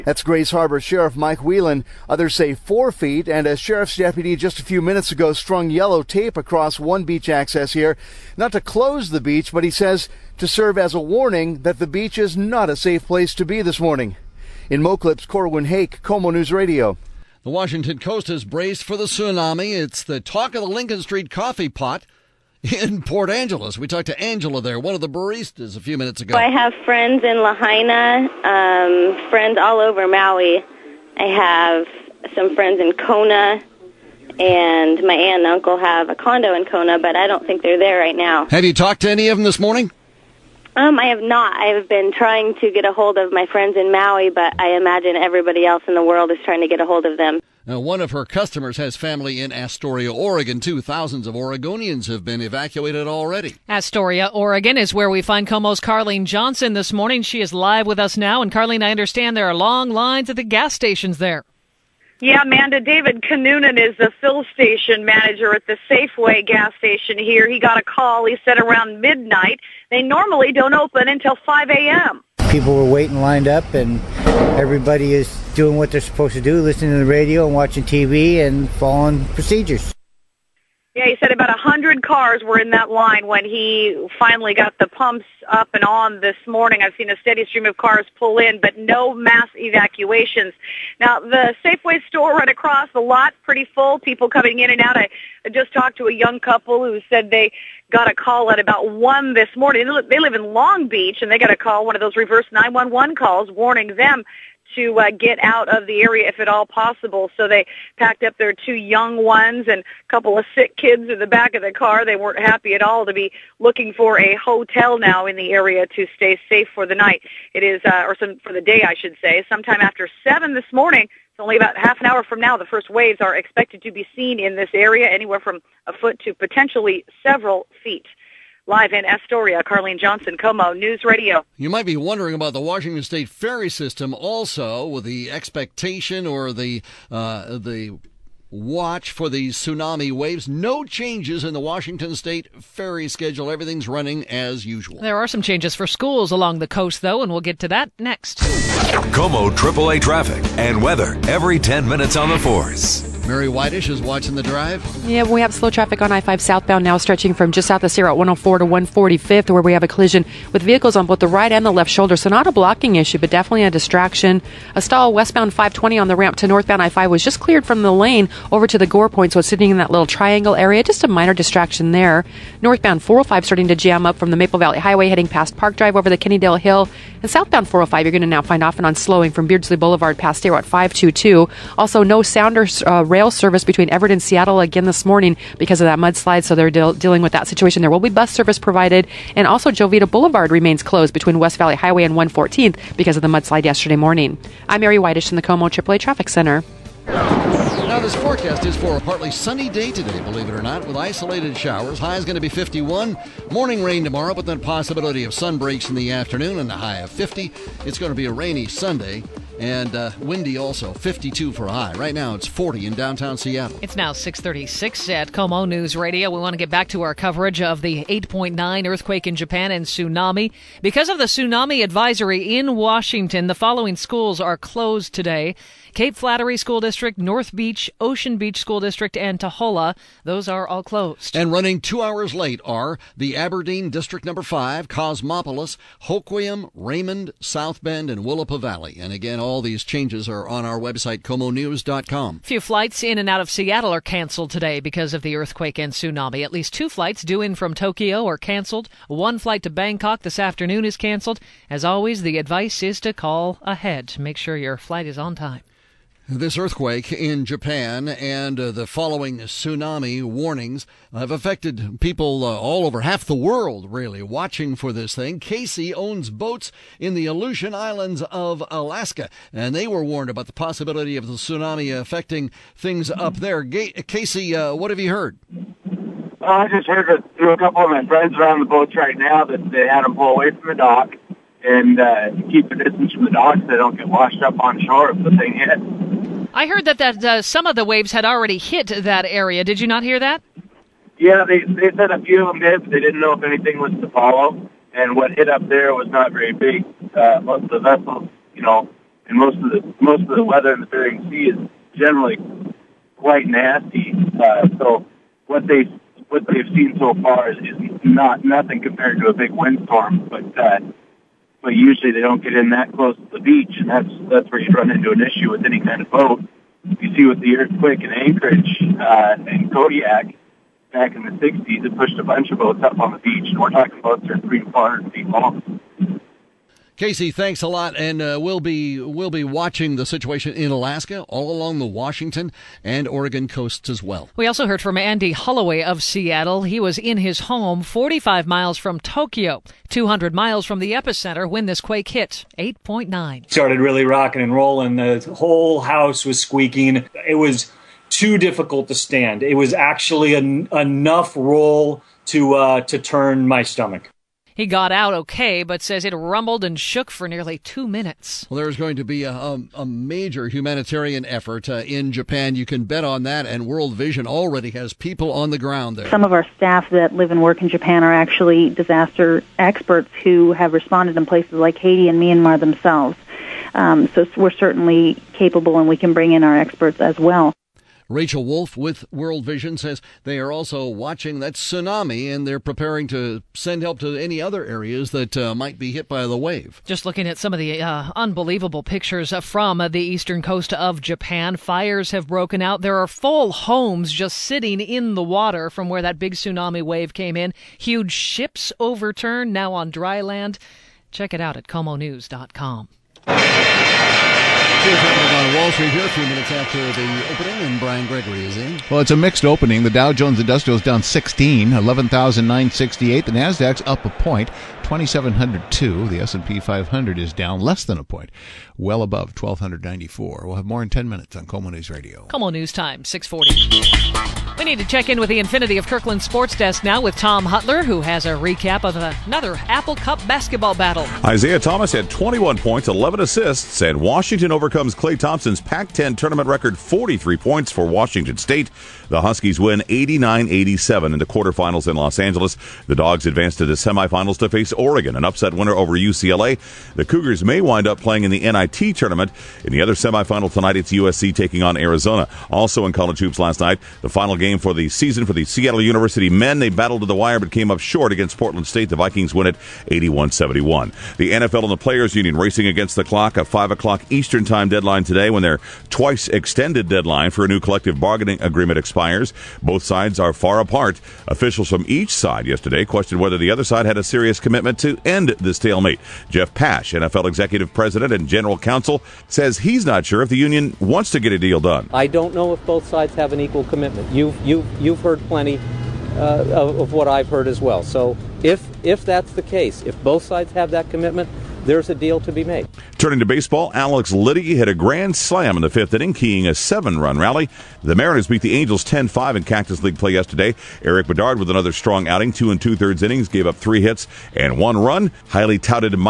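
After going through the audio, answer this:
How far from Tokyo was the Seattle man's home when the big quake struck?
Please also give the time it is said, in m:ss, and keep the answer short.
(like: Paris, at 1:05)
45 miles, at 5:37.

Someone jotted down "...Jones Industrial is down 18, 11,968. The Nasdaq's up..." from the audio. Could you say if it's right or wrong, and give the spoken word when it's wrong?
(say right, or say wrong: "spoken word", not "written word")
wrong: "16", not "18".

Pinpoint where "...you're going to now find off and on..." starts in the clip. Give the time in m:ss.
2:58.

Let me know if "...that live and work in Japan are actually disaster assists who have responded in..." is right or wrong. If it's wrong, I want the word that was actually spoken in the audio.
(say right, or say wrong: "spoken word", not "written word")
wrong: "experts", not "assists".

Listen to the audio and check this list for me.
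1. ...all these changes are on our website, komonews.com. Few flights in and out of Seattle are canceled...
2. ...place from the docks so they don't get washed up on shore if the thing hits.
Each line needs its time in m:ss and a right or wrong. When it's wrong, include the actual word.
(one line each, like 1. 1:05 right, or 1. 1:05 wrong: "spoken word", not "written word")
1. 3:59 right
2. 4:42 wrong: "distance", not "place".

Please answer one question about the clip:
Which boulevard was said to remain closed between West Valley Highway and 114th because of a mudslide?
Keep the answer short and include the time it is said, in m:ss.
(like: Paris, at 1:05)
Jovita Boulevard, at 3:09.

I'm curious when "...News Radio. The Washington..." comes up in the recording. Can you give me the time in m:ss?
0:16.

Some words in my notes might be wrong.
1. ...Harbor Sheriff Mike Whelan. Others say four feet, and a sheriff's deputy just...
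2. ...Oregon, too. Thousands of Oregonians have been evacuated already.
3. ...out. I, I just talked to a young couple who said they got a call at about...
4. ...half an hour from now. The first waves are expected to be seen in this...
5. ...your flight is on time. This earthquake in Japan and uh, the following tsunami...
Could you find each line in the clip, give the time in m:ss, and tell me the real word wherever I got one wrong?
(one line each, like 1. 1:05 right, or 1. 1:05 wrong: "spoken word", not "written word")
1. 0:00 right
2. 0:50 right
3. 1:34 right
4. 2:01 right
5. 4:14 right.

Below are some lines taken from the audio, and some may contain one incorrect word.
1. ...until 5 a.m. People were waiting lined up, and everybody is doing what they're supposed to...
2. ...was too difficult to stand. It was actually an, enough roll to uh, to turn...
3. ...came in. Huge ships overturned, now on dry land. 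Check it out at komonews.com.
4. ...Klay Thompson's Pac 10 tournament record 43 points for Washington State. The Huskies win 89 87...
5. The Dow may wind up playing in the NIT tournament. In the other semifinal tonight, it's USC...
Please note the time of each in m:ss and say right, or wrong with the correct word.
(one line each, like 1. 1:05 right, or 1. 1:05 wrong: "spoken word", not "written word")
1. 1:11 right
2. 5:47 right
3. 6:37 right
4. 7:14 right
5. 7:26 wrong: "Cougars", not "Dow".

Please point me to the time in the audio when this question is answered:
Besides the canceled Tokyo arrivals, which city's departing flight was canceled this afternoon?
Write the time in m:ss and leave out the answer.
4:09.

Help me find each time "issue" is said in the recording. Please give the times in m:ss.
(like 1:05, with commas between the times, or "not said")
2:42, 5:15.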